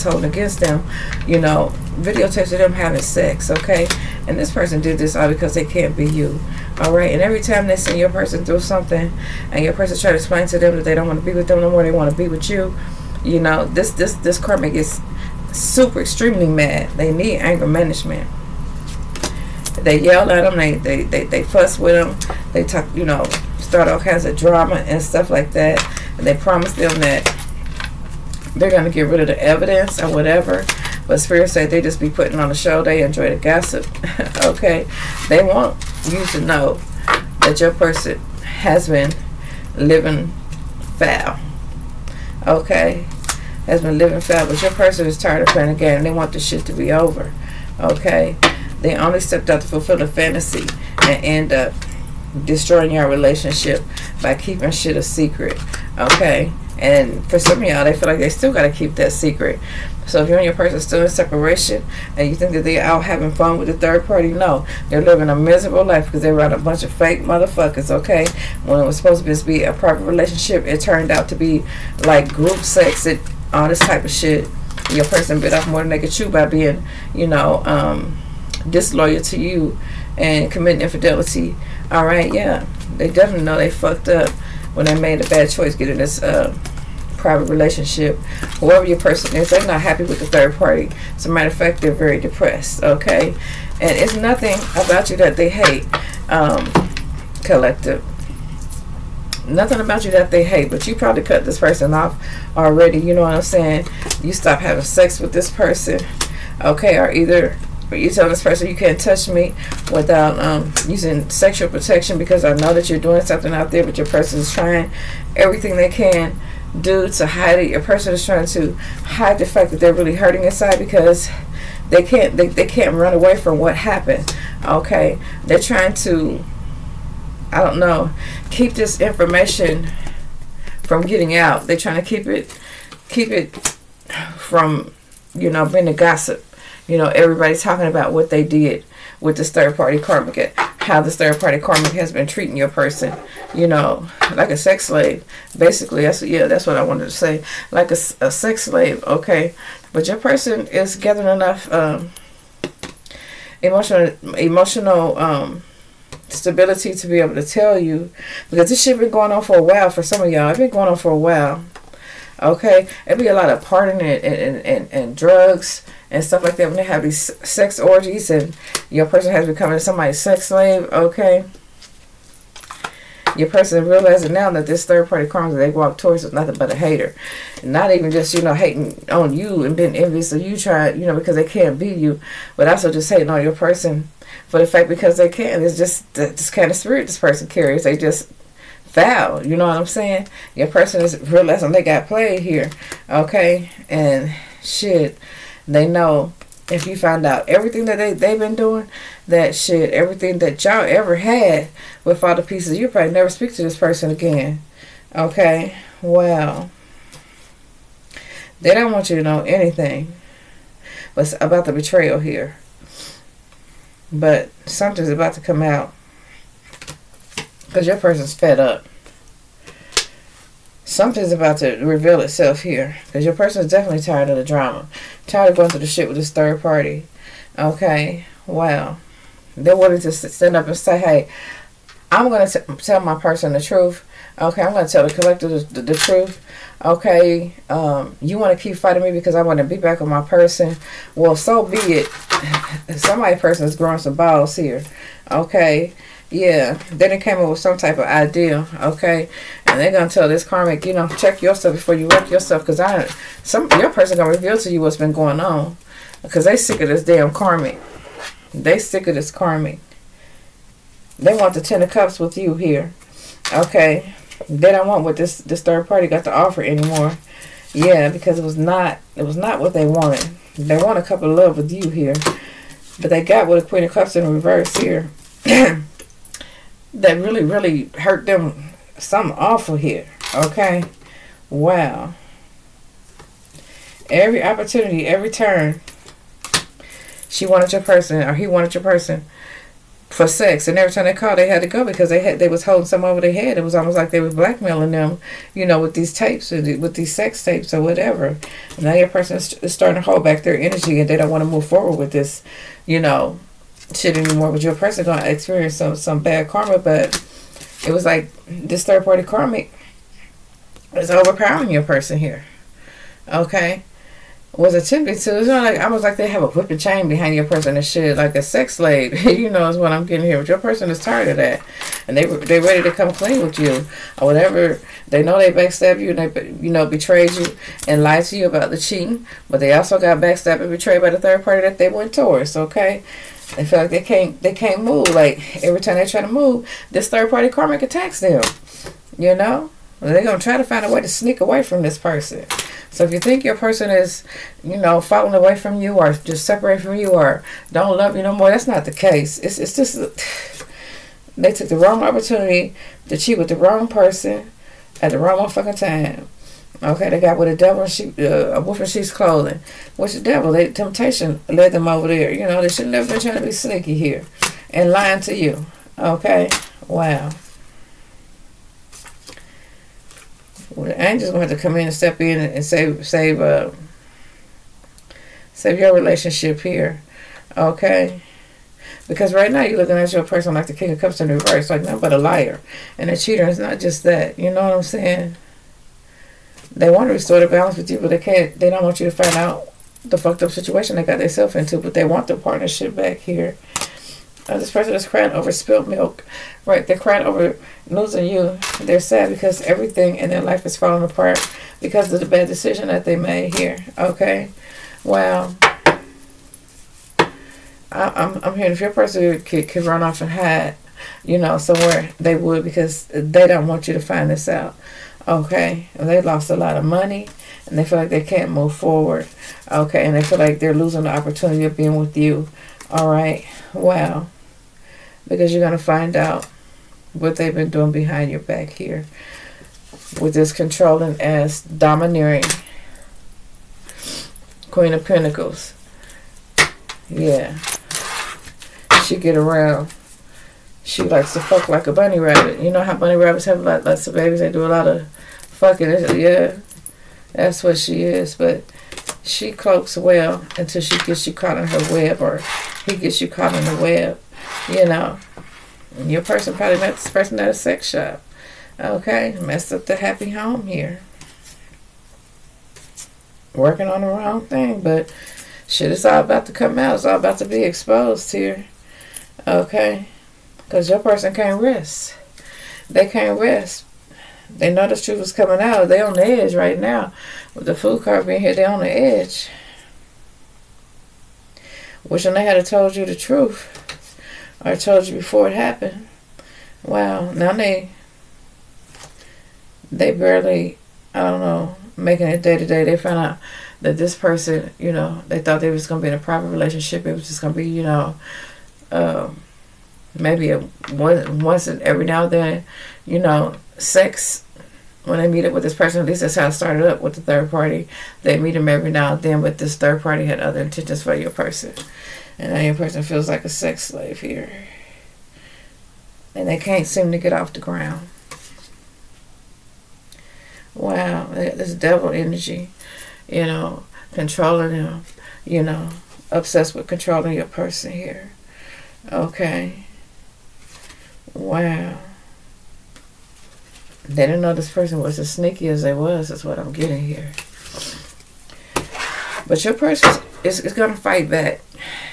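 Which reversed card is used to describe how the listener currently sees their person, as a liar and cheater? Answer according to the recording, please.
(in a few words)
King of Cups.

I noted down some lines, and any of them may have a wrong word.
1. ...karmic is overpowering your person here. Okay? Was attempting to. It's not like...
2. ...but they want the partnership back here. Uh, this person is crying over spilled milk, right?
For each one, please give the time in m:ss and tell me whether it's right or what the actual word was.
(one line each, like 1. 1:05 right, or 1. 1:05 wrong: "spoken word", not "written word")
1. 5:09 right
2. 6:31 right.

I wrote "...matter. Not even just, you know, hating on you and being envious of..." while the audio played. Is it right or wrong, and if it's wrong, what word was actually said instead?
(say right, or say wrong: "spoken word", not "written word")
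wrong: "hater", not "matter".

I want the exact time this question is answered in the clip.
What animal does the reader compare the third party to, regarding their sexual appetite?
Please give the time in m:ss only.
7:21.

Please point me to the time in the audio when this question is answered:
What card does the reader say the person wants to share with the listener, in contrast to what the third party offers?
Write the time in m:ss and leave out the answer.
4:21.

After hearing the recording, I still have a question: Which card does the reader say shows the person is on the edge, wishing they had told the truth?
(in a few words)
The Fool.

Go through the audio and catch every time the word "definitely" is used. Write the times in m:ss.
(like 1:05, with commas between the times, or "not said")
1:23, 3:43.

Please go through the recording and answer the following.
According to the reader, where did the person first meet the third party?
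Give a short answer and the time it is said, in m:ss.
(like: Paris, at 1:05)
a sex shop, at 7:37.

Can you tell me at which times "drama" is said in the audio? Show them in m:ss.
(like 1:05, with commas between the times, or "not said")
0:24, 3:44.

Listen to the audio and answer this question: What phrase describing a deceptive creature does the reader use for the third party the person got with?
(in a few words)
wolf in sheep's clothing.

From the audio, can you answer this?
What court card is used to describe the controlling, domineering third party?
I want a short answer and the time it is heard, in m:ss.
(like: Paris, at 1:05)
Queen of Pentacles, at 7:14.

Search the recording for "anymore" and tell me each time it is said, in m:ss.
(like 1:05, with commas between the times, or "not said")
4:26, 5:04.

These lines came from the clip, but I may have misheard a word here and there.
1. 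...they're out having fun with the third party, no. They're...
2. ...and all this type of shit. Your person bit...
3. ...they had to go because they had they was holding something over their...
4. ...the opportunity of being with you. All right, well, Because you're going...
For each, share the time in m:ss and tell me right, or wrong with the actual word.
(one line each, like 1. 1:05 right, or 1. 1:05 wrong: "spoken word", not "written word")
1. 1:02 right
2. 1:13 right
3. 4:51 right
4. 7:01 right.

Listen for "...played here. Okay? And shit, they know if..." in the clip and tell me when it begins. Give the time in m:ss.
3:12.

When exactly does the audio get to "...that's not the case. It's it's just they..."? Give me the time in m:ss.
5:48.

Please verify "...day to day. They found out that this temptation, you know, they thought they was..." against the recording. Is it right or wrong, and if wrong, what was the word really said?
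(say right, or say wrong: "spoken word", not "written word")
wrong: "person", not "temptation".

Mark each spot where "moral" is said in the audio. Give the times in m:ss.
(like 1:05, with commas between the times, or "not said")
not said.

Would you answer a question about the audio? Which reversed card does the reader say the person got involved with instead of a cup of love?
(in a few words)
Queen of Cups.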